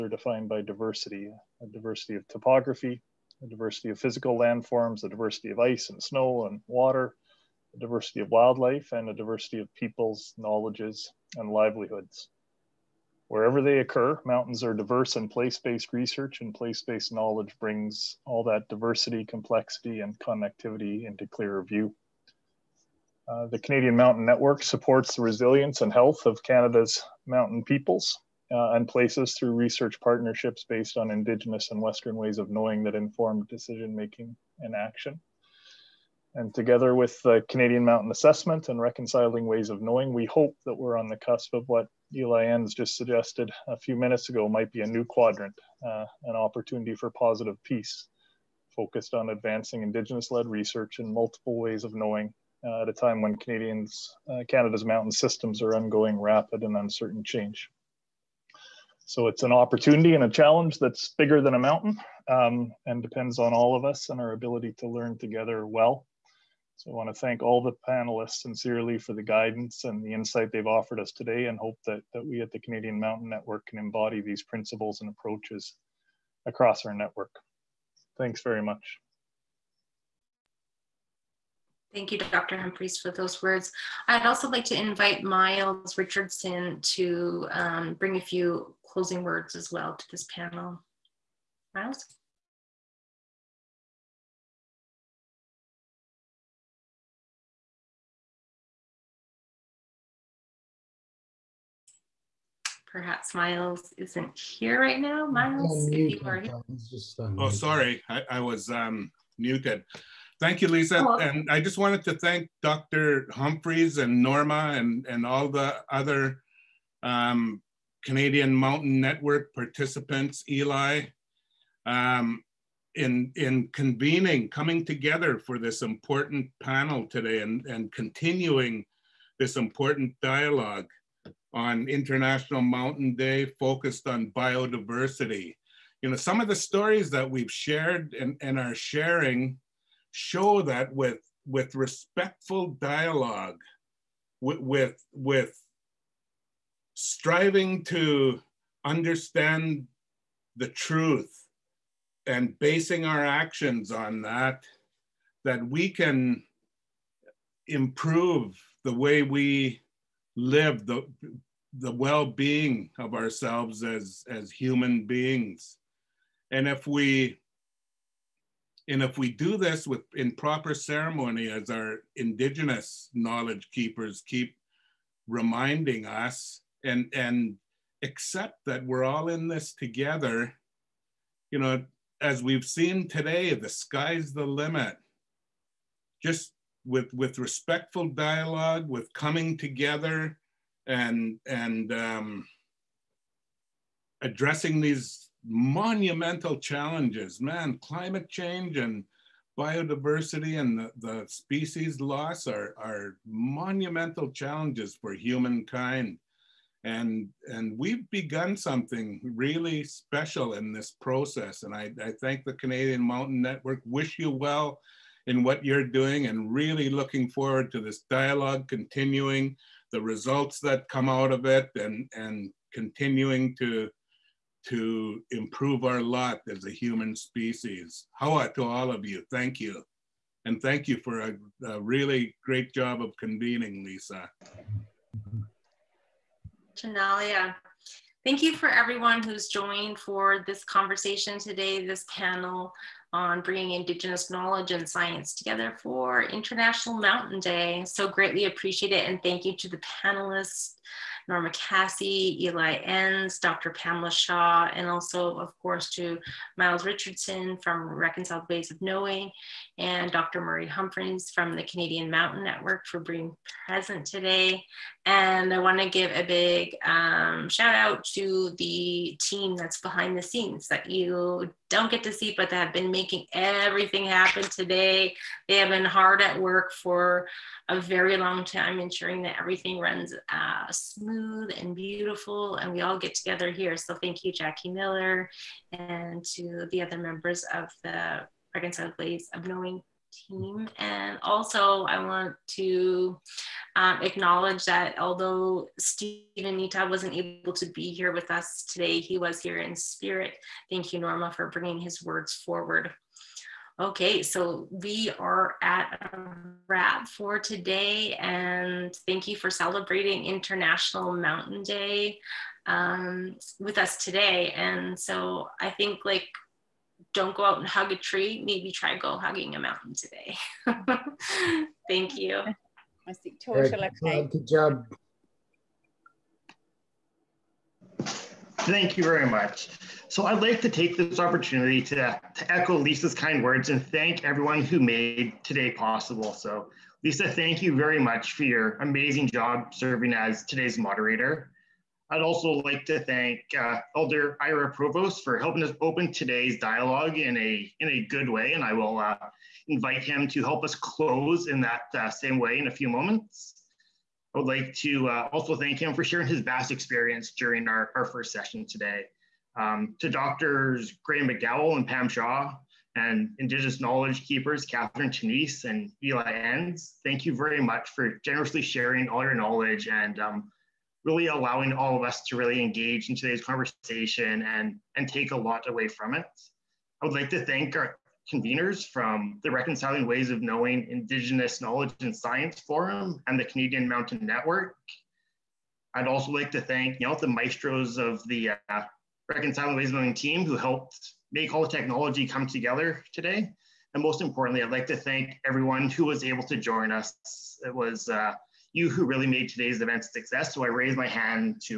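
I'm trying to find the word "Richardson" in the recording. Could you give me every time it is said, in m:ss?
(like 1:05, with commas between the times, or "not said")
1:25, 4:16.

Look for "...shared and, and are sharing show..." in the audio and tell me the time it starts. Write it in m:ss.
2:17.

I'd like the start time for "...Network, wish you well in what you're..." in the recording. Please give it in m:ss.
3:33.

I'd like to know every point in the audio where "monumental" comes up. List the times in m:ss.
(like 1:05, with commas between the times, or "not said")
3:15, 3:23.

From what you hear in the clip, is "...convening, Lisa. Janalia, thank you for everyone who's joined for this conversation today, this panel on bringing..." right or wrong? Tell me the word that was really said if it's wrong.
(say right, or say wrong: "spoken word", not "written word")
right.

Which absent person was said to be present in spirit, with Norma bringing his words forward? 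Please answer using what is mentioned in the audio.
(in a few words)
Steven Nitah.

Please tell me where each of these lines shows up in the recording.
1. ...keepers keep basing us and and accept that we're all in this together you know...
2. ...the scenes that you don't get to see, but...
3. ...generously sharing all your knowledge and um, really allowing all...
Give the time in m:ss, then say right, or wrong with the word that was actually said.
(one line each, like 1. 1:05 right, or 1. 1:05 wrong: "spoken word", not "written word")
1. 2:53 wrong: "reminding", not "basing"
2. 4:30 right
3. 6:08 right.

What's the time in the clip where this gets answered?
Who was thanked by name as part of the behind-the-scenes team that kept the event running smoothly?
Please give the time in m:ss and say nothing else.
4:44.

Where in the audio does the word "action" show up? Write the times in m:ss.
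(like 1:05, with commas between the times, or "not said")
0:34, 2:33.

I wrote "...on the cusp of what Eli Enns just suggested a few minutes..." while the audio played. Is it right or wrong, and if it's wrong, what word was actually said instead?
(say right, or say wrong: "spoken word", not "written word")
right.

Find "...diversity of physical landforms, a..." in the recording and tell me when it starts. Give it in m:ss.
0:03.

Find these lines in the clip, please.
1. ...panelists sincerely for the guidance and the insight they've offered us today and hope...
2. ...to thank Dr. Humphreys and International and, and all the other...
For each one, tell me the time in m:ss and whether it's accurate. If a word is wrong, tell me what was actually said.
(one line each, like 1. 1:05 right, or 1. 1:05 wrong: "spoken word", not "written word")
1. 1:07 right
2. 1:52 wrong: "Norma", not "International".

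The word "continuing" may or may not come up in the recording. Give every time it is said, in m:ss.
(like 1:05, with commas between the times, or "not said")
2:07, 3:38, 3:42.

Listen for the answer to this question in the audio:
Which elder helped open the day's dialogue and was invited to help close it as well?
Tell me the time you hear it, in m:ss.
5:44.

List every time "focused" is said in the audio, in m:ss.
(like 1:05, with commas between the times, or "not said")
0:48, 2:13.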